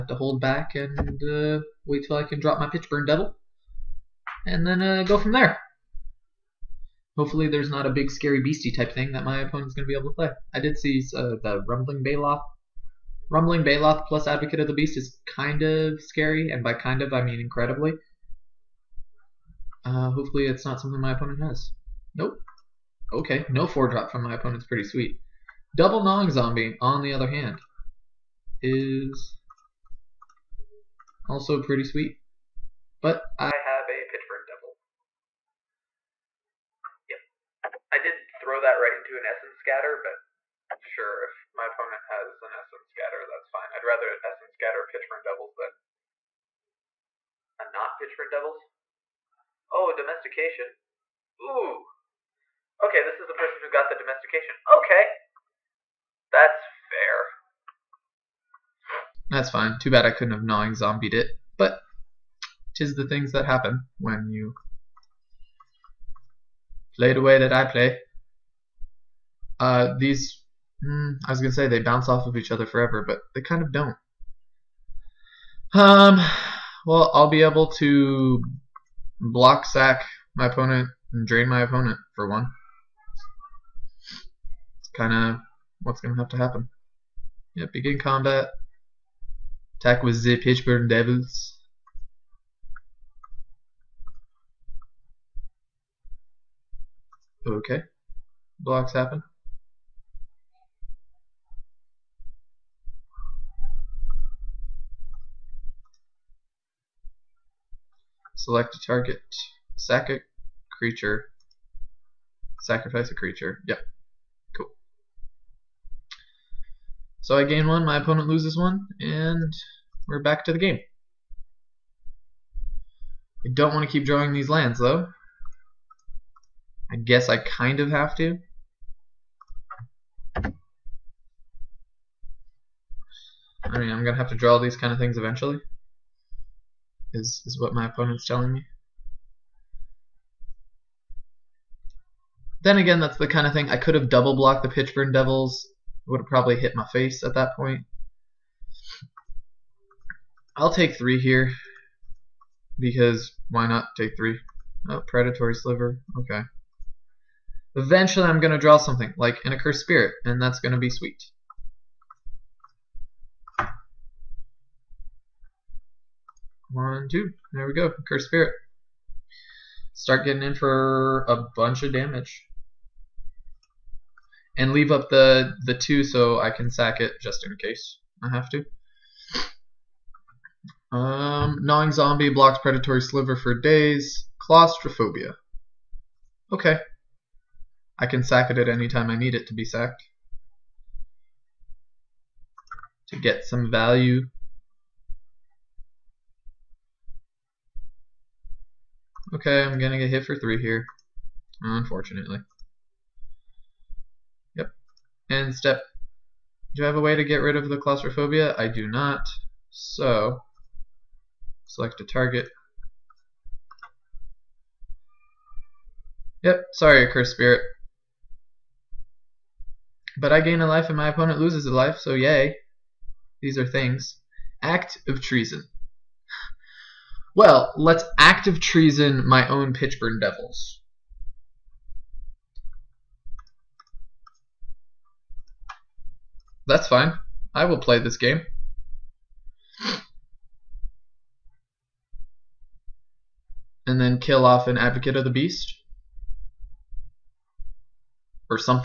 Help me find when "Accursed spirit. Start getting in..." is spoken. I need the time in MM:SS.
02:47.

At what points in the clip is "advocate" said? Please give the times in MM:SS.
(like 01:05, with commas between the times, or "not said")
00:14, 04:04.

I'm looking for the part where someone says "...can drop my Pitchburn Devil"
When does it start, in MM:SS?
00:02.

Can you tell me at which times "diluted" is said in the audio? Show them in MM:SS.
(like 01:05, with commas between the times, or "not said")
not said.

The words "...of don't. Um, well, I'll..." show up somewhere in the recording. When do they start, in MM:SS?
01:13.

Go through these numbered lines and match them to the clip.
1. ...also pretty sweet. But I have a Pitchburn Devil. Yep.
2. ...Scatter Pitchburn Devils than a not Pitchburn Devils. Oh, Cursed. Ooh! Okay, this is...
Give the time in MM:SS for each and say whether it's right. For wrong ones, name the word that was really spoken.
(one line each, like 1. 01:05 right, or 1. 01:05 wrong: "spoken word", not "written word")
1. 00:31 right
2. 00:44 wrong: "Domestication", not "Cursed".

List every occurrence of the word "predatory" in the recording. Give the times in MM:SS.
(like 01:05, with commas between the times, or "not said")
02:35, 03:02.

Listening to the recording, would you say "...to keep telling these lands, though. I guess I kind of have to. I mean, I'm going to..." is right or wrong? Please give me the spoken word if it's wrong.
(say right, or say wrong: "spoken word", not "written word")
wrong: "drawing", not "telling".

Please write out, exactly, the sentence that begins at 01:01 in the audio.
But tis the things that happen when you play the way that I play.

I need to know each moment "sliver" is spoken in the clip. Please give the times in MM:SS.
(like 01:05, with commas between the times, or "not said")
02:35, 03:03.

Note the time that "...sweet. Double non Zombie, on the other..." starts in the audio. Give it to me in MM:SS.
00:24.